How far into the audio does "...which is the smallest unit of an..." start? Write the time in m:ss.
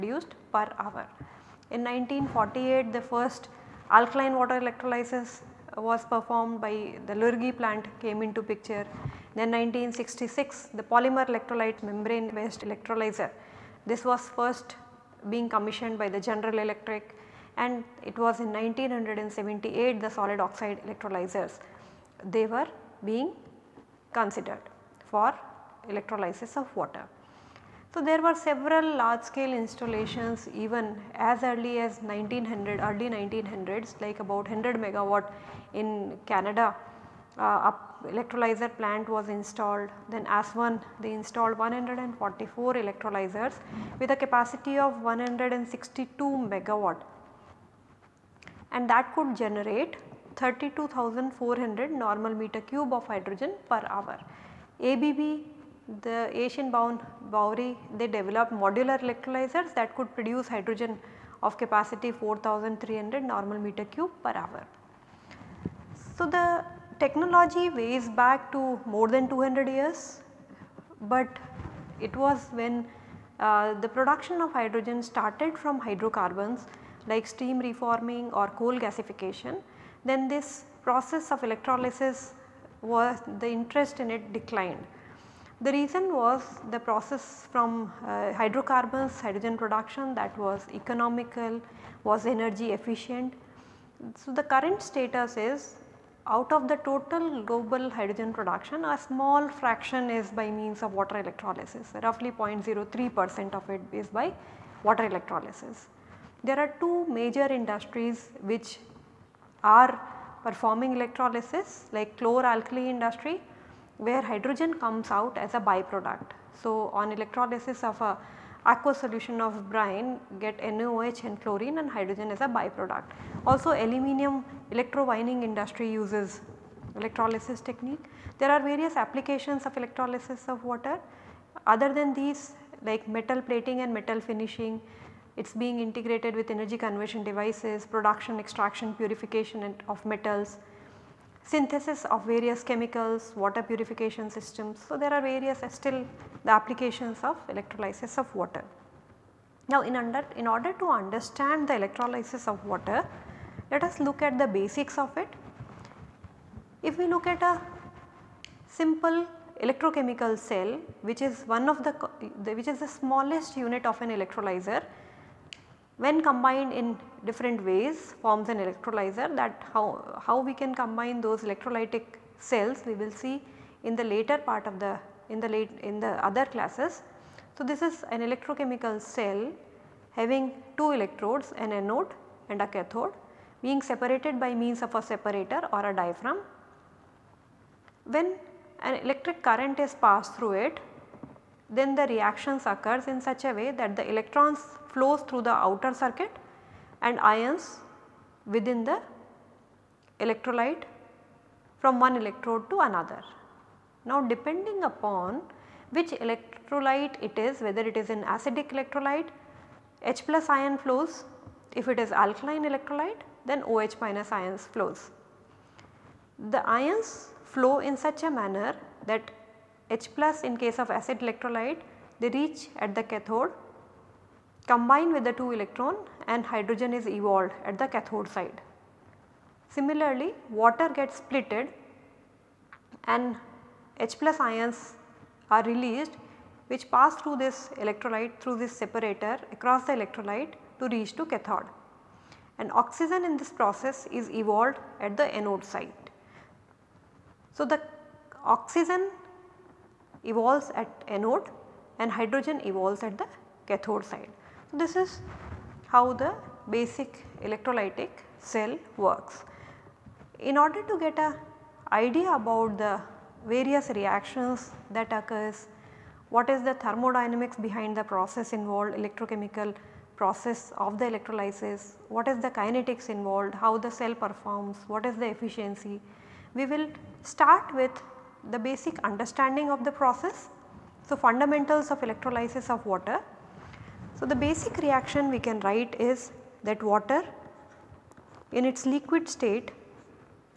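2:42.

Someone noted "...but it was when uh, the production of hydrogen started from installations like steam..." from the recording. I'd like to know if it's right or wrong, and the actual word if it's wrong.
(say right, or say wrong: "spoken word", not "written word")
wrong: "hydrocarbons", not "installations".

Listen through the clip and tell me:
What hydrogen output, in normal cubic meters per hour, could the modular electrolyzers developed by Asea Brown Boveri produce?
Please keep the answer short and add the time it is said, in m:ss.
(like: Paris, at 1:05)
4300, at 1:02.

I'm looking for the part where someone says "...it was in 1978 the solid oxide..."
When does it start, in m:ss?
0:18.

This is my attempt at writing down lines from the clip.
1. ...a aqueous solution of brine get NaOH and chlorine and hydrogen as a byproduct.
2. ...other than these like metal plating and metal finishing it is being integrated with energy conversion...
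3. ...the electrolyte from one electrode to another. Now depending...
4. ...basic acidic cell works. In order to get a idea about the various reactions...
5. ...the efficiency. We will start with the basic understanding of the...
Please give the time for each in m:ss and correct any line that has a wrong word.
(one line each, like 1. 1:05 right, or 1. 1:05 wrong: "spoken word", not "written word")
1. 1:58 right
2. 2:11 right
3. 3:18 right
4. 4:16 wrong: "electrolytic", not "acidic"
5. 4:35 right.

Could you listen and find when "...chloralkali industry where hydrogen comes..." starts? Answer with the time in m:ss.
1:52.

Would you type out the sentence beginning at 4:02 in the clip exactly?
And oxygen in this process is evolved at the anode side.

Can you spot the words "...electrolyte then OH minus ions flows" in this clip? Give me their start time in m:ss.
3:32.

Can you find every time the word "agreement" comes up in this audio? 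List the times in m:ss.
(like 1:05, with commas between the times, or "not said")
not said.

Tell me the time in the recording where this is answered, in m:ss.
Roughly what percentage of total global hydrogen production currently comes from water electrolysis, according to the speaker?
1:42.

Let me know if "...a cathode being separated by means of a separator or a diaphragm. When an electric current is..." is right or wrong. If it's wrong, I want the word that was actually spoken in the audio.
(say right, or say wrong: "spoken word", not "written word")
right.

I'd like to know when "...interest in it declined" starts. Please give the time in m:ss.
1:23.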